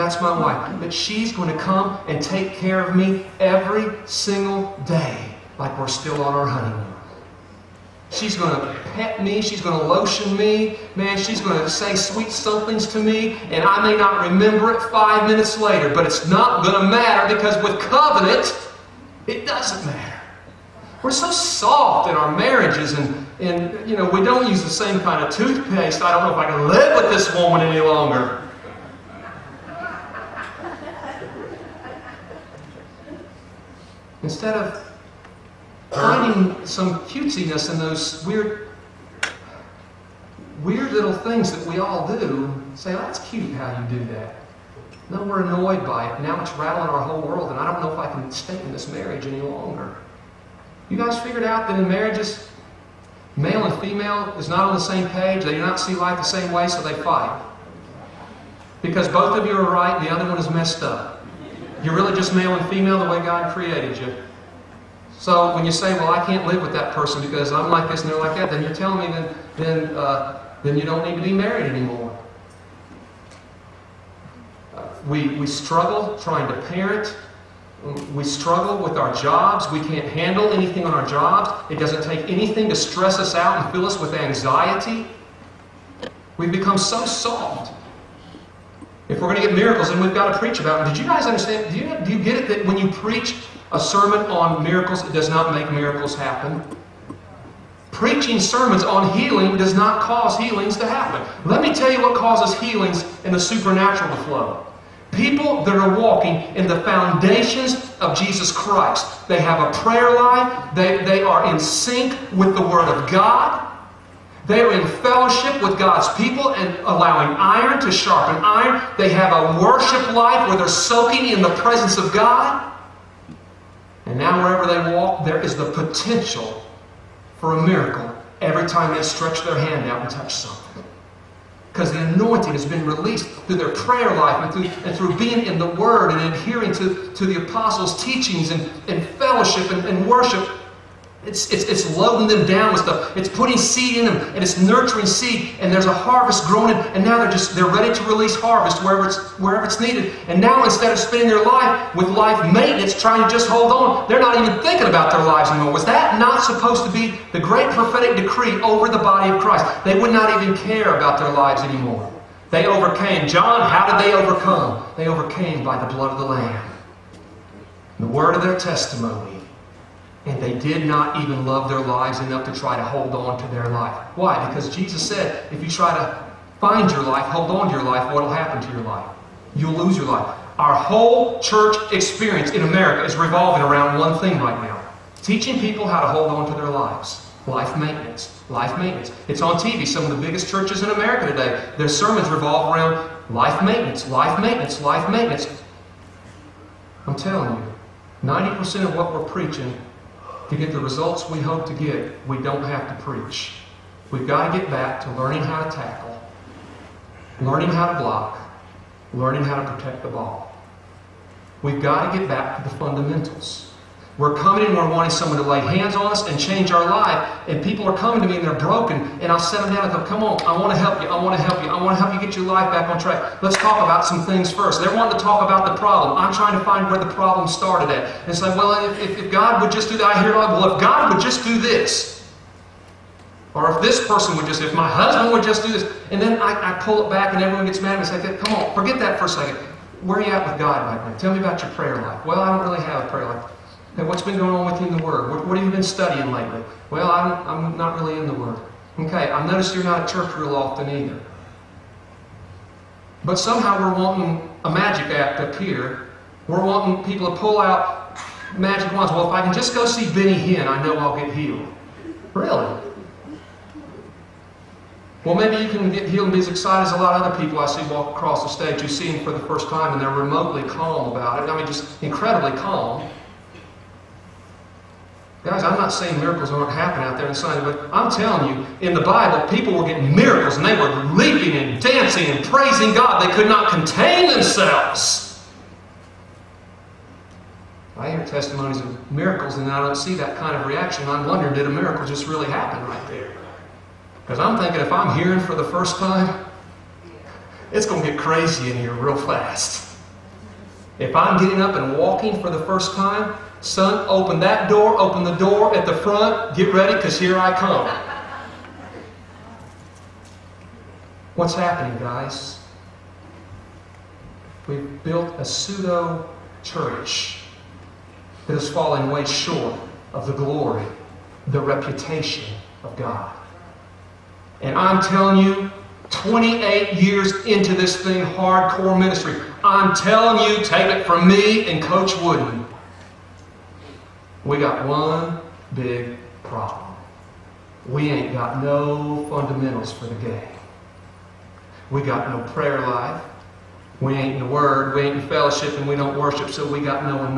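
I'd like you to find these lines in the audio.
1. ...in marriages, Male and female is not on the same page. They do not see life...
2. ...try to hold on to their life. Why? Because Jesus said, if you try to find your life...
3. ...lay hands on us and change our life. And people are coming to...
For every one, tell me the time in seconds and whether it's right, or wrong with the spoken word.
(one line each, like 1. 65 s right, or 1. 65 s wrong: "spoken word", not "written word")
1. 51 s right
2. 172 s right
3. 215 s right.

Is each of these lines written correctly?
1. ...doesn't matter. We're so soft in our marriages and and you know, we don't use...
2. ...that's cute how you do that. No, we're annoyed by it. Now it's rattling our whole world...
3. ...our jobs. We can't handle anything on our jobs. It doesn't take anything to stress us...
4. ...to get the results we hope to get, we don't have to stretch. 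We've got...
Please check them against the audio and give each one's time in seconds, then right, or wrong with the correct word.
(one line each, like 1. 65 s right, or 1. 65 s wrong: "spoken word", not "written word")
1. 19 s right
2. 42 s right
3. 78 s right
4. 200 s wrong: "preach", not "stretch".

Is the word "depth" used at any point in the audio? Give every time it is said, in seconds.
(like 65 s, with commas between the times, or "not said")
not said.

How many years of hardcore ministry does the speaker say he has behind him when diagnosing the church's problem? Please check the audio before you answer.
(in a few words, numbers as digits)
28.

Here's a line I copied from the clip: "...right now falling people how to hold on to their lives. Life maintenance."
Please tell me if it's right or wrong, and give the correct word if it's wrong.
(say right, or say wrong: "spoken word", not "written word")
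wrong: "teaching", not "falling".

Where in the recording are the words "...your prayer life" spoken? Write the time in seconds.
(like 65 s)
241 s.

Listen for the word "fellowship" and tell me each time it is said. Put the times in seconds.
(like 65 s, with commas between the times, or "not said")
114 s, 139 s, 345 s.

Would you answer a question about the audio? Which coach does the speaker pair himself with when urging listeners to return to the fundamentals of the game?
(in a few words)
Coach Wooden.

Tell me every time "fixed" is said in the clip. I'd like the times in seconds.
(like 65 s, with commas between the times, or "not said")
not said.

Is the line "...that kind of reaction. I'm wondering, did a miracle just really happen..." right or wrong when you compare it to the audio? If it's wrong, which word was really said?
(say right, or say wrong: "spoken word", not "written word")
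right.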